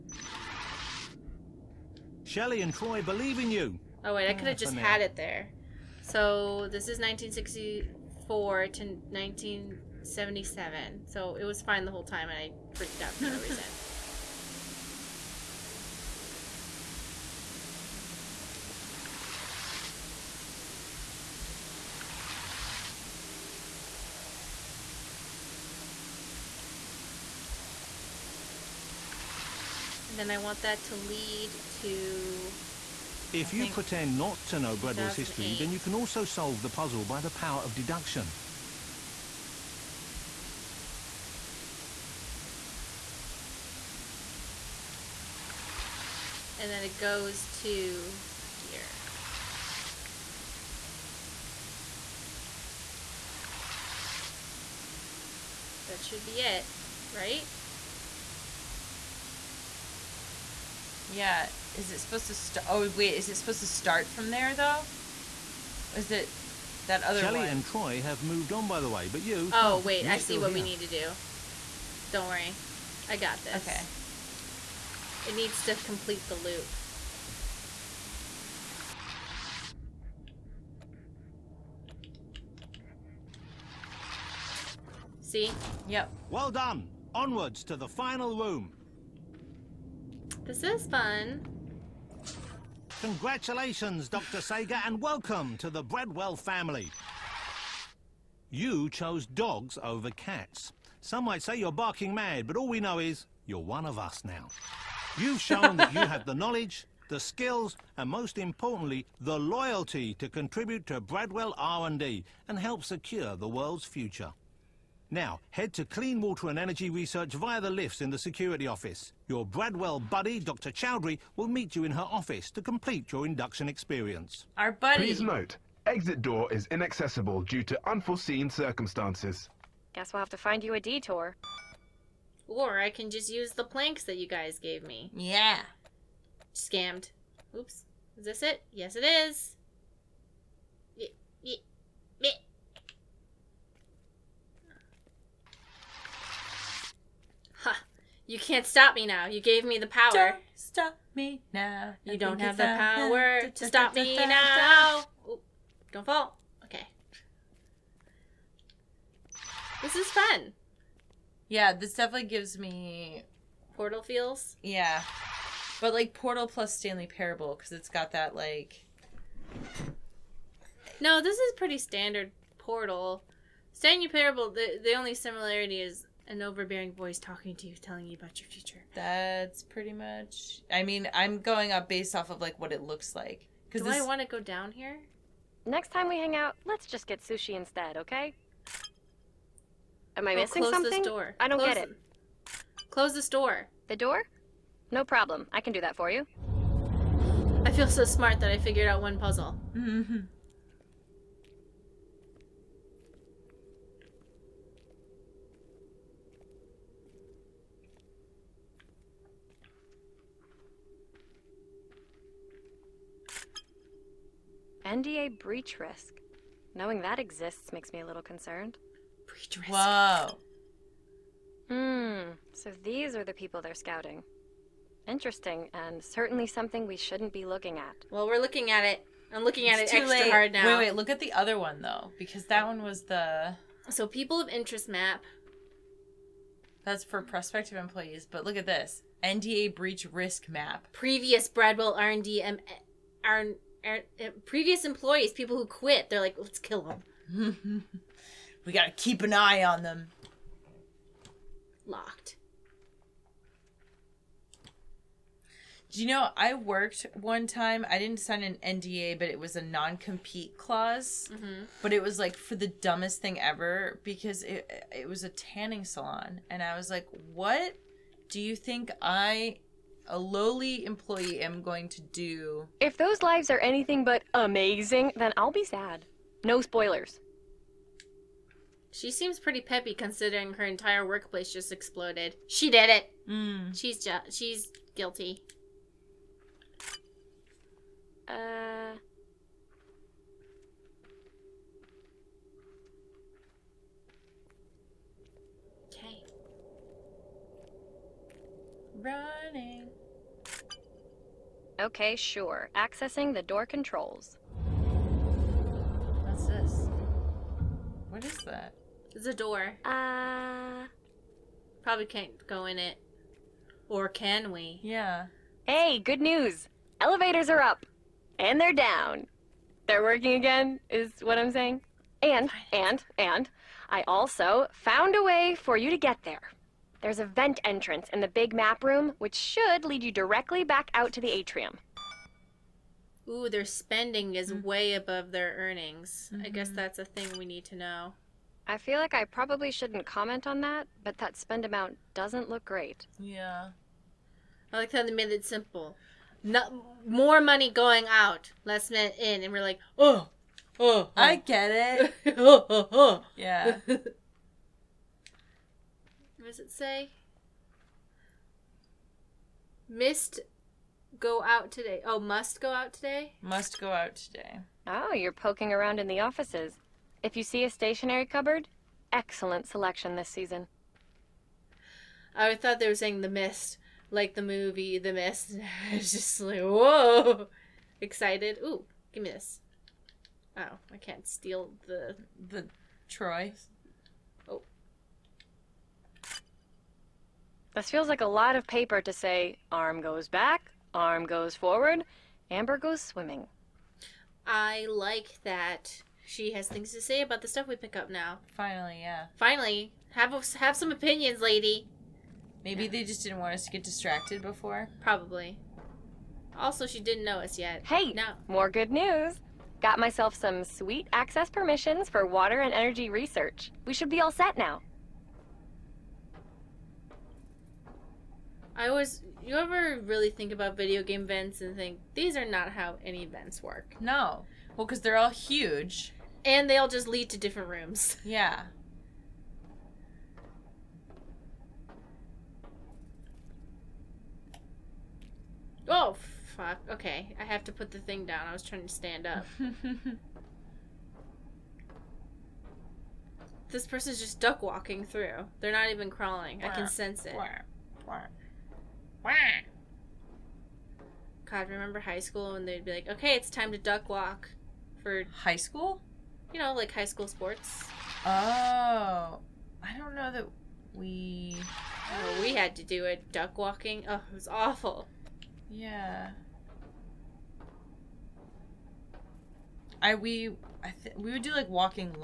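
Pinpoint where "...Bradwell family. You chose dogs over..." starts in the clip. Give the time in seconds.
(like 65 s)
95 s.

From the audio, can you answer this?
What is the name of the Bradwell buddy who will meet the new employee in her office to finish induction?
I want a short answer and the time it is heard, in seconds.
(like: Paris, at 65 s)
Dr. Chowdhury, at 120 s.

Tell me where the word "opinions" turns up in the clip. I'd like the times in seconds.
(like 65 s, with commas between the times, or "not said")
400 s.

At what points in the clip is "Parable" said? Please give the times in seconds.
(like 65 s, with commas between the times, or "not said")
167 s, 174 s.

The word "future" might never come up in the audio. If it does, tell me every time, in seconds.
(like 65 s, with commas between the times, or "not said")
113 s, 178 s.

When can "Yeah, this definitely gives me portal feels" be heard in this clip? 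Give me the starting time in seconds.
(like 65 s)
161 s.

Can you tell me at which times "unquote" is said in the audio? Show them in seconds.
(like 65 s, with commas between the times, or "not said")
not said.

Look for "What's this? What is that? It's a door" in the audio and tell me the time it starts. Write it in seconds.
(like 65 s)
306 s.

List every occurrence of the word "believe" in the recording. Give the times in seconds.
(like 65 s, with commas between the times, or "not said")
3 s.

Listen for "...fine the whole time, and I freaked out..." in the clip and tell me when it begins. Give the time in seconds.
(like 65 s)
11 s.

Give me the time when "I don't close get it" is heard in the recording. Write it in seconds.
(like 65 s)
191 s.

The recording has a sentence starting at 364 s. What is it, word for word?
Oh, you're poking around in the offices.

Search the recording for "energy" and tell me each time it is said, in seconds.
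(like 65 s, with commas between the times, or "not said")
116 s, 412 s.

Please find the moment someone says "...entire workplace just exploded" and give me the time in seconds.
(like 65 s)
280 s.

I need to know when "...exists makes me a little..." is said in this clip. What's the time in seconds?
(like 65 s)
217 s.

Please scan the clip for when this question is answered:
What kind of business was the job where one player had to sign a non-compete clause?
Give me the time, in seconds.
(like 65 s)
265 s.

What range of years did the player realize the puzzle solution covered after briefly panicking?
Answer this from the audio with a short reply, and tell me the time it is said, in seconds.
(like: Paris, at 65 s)
1964 to 1977, at 6 s.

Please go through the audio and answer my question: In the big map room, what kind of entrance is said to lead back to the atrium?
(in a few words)
A vent.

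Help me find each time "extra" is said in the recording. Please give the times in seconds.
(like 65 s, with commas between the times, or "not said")
229 s.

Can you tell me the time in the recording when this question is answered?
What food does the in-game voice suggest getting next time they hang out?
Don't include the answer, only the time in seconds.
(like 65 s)
187 s.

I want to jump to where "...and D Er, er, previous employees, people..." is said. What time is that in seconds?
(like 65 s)
243 s.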